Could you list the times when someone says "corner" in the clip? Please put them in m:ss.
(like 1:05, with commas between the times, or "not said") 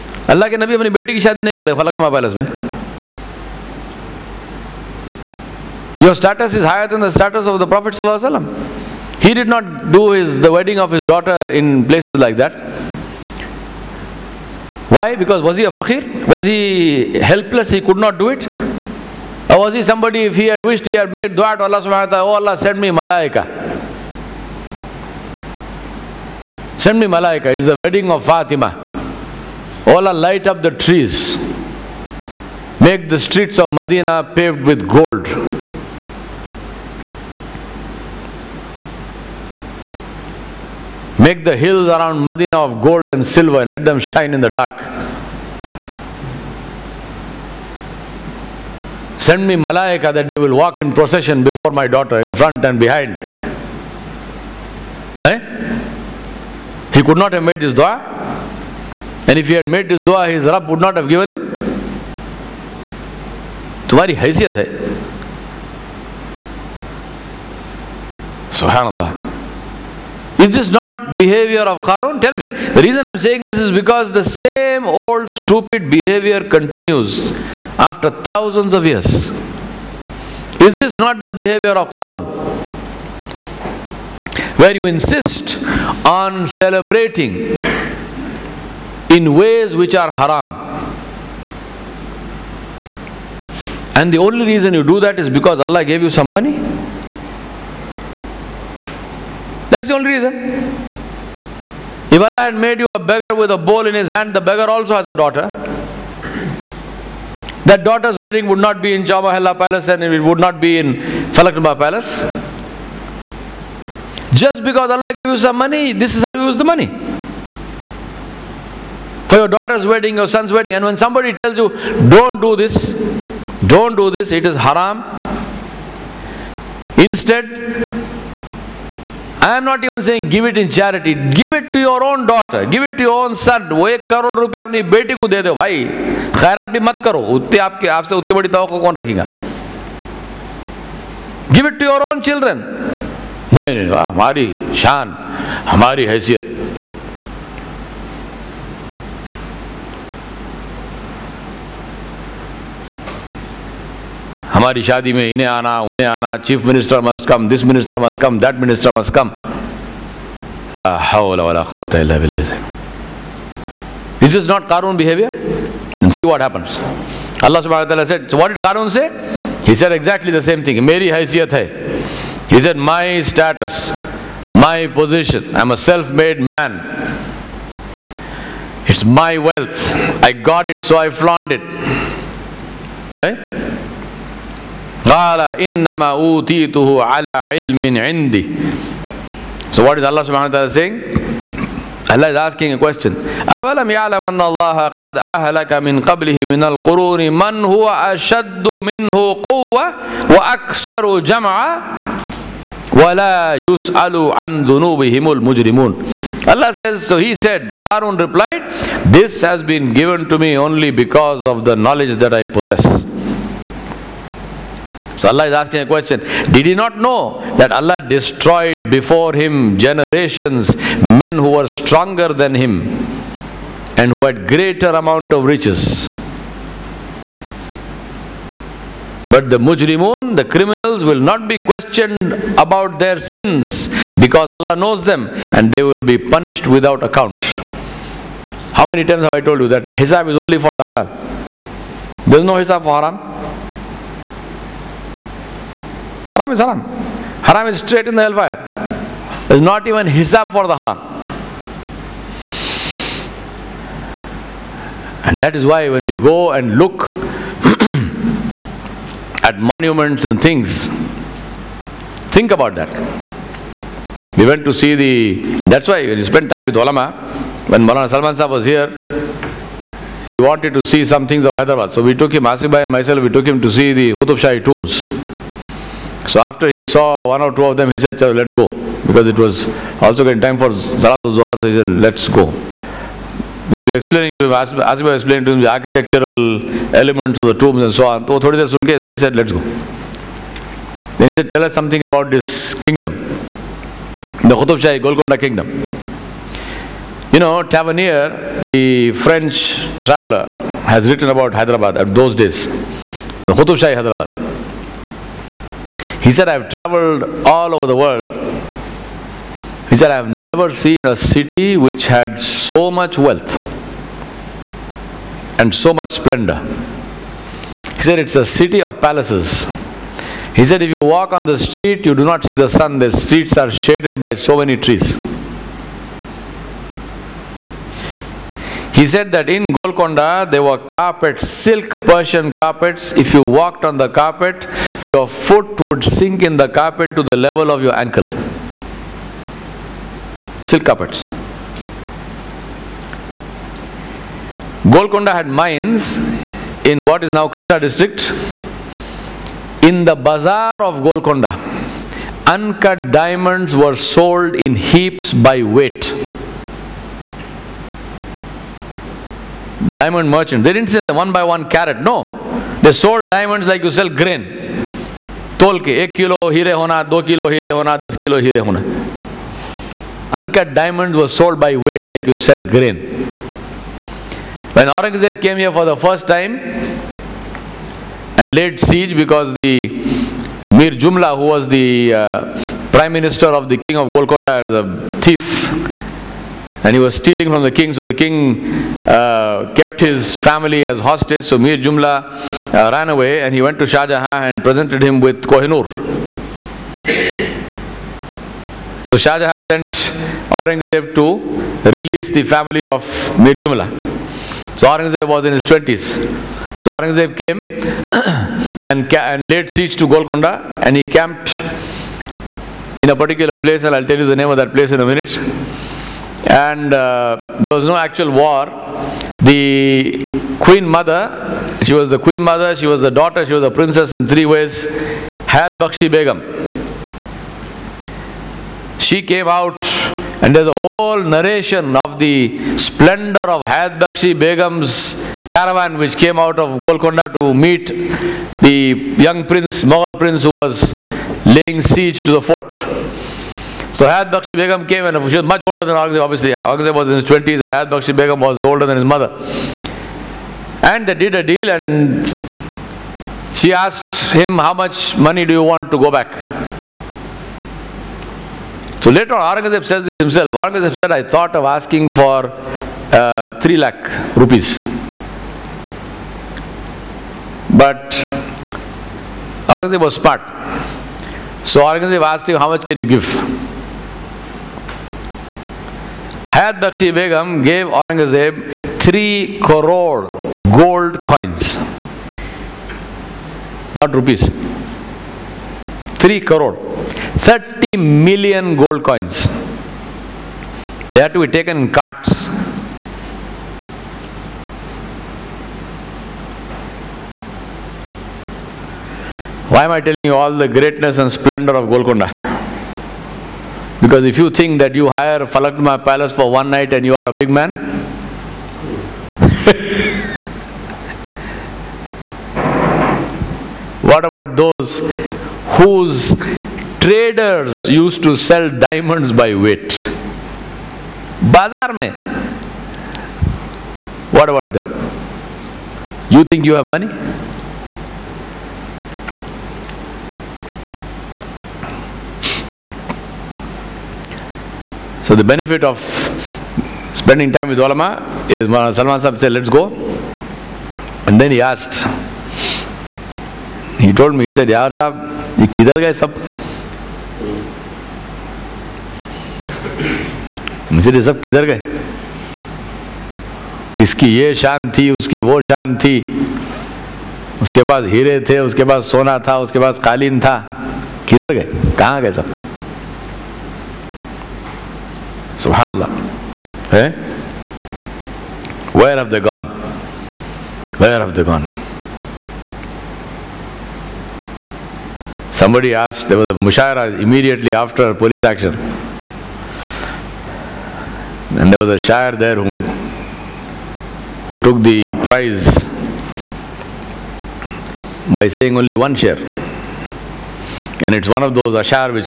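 not said.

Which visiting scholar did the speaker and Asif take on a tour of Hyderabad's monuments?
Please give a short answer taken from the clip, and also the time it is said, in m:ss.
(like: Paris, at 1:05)
Maulana Salman Sahib, at 4:27.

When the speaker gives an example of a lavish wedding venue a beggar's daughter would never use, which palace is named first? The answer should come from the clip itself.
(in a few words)
Chowmahalla Palace.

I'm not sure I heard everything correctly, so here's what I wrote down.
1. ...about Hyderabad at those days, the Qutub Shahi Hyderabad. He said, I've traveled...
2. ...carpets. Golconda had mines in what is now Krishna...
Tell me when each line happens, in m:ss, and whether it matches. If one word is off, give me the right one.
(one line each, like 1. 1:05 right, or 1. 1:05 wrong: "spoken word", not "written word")
1. 5:01 right
2. 5:40 right.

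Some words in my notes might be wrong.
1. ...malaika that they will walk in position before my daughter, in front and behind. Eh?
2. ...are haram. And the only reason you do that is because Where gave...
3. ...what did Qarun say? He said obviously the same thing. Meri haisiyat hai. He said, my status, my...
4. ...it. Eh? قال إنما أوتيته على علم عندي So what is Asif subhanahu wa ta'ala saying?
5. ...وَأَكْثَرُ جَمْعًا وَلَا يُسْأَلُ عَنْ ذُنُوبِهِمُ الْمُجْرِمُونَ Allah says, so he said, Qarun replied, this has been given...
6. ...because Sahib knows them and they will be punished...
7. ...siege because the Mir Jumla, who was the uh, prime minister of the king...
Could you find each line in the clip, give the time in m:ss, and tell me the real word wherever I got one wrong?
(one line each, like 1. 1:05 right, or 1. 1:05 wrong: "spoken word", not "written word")
1. 0:49 wrong: "procession", not "position"
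2. 1:29 wrong: "Allah", not "Where"
3. 2:48 wrong: "exactly", not "obviously"
4. 3:01 wrong: "Allah", not "Asif"
5. 3:20 right
6. 3:54 wrong: "Allah", not "Sahib"
7. 6:18 right.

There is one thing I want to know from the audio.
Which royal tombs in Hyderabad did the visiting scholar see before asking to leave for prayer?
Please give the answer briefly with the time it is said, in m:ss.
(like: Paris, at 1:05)
Qutub Shahi tombs, at 4:34.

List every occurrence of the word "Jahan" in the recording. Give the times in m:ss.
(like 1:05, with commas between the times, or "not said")
6:34, 6:39.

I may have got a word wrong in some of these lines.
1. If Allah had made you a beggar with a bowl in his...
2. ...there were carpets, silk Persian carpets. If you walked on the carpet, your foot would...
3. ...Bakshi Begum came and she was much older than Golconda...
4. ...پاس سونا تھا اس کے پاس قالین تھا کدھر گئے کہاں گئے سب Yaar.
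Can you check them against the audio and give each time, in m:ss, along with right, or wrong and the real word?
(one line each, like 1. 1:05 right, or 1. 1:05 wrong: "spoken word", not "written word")
1. 1:42 right
2. 5:30 right
3. 7:24 wrong: "Aurangzeb", not "Golconda"
4. 9:18 wrong: "Subhanallah", not "Yaar".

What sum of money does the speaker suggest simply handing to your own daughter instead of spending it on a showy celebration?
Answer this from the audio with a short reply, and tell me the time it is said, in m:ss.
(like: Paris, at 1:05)
1 crore rupees, at 2:13.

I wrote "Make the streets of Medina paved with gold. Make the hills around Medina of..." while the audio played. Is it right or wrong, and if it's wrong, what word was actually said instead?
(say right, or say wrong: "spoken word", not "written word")
right.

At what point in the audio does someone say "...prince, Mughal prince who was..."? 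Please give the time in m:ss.
7:19.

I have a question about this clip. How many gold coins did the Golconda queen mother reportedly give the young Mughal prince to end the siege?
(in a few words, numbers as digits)
3 crore.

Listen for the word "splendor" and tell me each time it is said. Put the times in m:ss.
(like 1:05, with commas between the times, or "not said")
5:16, 7:12, 8:21.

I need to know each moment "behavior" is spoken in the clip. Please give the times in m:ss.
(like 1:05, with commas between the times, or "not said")
1:11, 1:15, 1:21.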